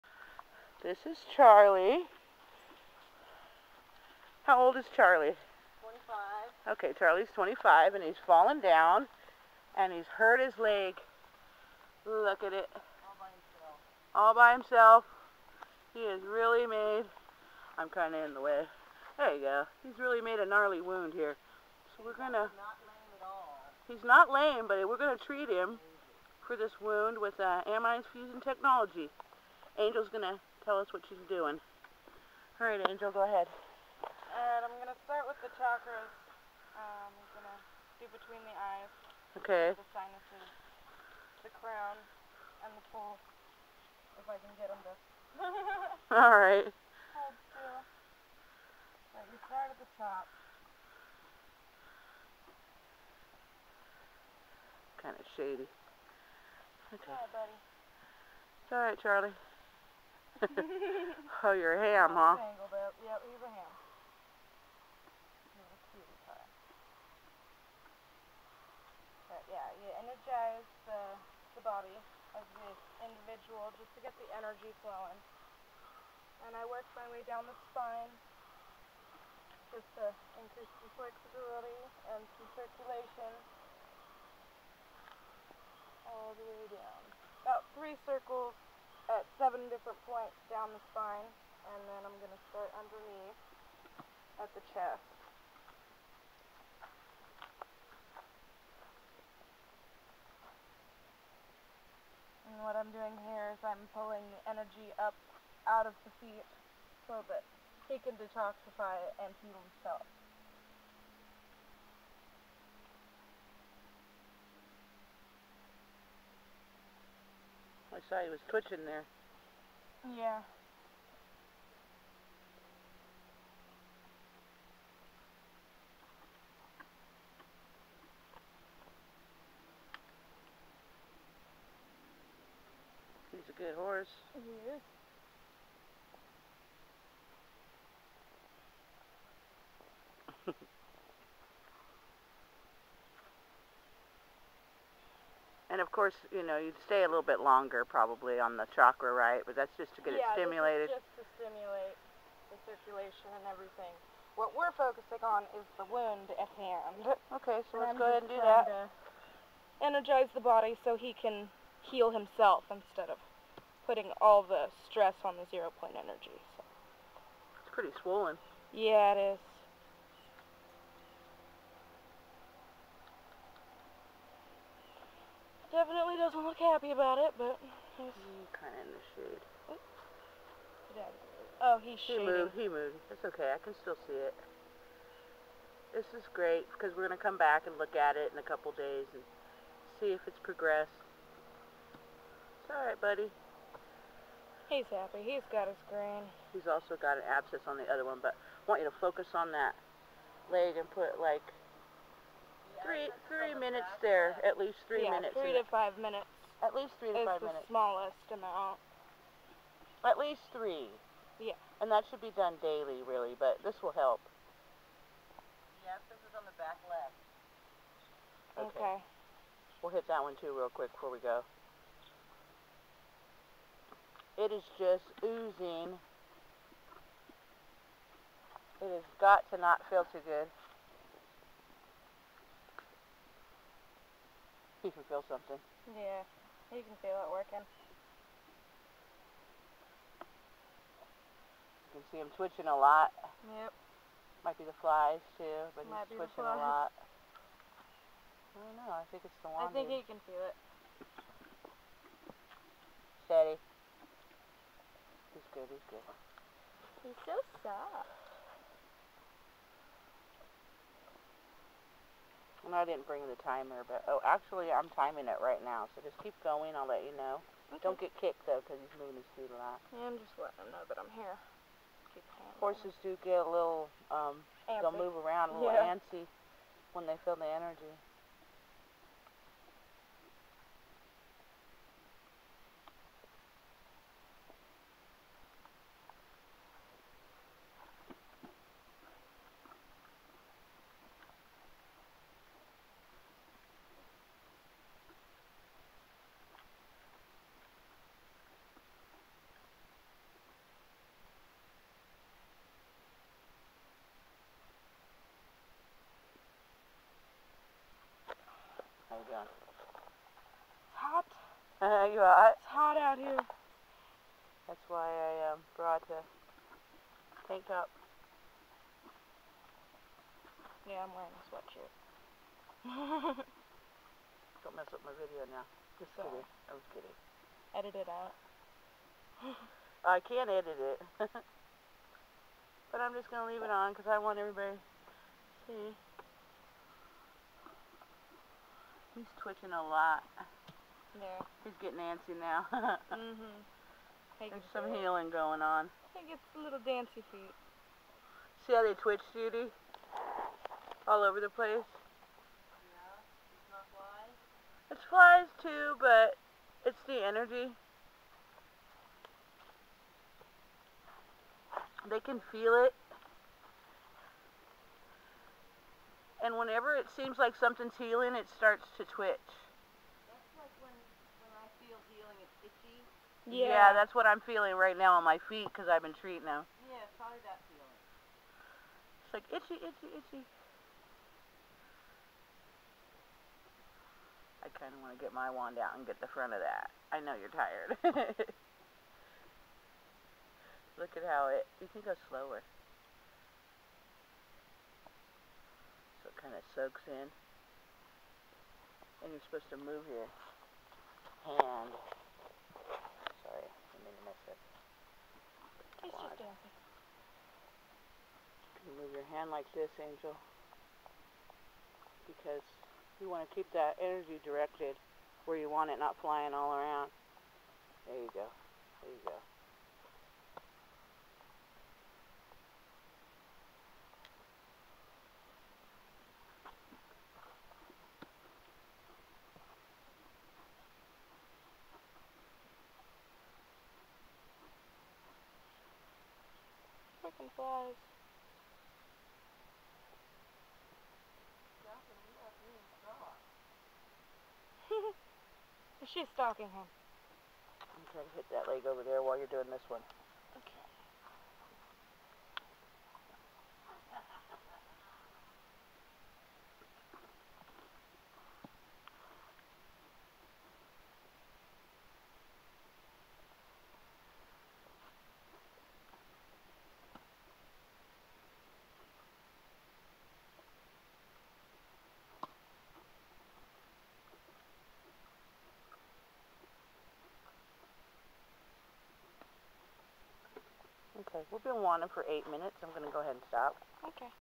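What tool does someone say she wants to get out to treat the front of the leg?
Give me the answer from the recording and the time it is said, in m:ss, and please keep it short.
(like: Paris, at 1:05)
wand, at 6:25.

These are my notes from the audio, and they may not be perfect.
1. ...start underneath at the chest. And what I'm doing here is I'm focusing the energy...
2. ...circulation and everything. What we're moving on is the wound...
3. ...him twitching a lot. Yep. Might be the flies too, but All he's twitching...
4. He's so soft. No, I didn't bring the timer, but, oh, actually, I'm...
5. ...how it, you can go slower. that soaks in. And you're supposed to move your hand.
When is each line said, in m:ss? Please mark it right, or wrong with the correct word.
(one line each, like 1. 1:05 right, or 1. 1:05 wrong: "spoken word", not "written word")
1. 1:32 wrong: "pulling", not "focusing"
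2. 2:32 wrong: "focusing", not "moving"
3. 4:02 wrong: "Might", not "All"
4. 4:17 right
5. 6:31 right.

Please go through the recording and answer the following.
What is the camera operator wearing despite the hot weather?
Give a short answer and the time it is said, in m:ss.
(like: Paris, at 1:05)
sweatshirt, at 5:21.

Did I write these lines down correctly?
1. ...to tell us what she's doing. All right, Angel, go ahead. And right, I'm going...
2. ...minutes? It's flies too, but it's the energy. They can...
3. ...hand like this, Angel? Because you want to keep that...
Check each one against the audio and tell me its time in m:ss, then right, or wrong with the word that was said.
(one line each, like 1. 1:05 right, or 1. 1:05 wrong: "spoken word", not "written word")
1. 0:30 right
2. 5:55 wrong: "flies", not "minutes"
3. 6:49 right.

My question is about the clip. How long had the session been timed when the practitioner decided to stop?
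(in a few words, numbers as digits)
8 minutes.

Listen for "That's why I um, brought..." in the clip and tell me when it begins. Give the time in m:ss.
5:14.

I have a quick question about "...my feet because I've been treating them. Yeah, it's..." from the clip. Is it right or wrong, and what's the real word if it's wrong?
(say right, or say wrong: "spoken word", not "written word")
right.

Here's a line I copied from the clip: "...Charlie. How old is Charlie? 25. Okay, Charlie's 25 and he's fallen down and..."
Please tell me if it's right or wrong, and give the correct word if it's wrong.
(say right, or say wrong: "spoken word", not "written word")
right.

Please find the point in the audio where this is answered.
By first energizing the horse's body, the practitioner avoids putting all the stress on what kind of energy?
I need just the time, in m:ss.
2:45.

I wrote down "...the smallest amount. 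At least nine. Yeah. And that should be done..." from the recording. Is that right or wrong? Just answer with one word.
wrong.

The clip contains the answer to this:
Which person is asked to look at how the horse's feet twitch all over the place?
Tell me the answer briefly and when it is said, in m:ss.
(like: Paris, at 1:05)
Judy, at 5:49.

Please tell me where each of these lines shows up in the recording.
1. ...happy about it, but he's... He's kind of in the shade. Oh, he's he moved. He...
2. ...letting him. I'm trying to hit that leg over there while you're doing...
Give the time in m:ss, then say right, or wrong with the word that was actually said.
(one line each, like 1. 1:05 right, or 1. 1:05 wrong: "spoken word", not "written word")
1. 2:56 right
2. 7:26 wrong: "stalking", not "letting".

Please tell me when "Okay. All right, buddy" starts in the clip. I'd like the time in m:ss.
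0:56.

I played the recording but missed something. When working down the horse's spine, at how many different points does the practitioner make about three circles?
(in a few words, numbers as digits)
7.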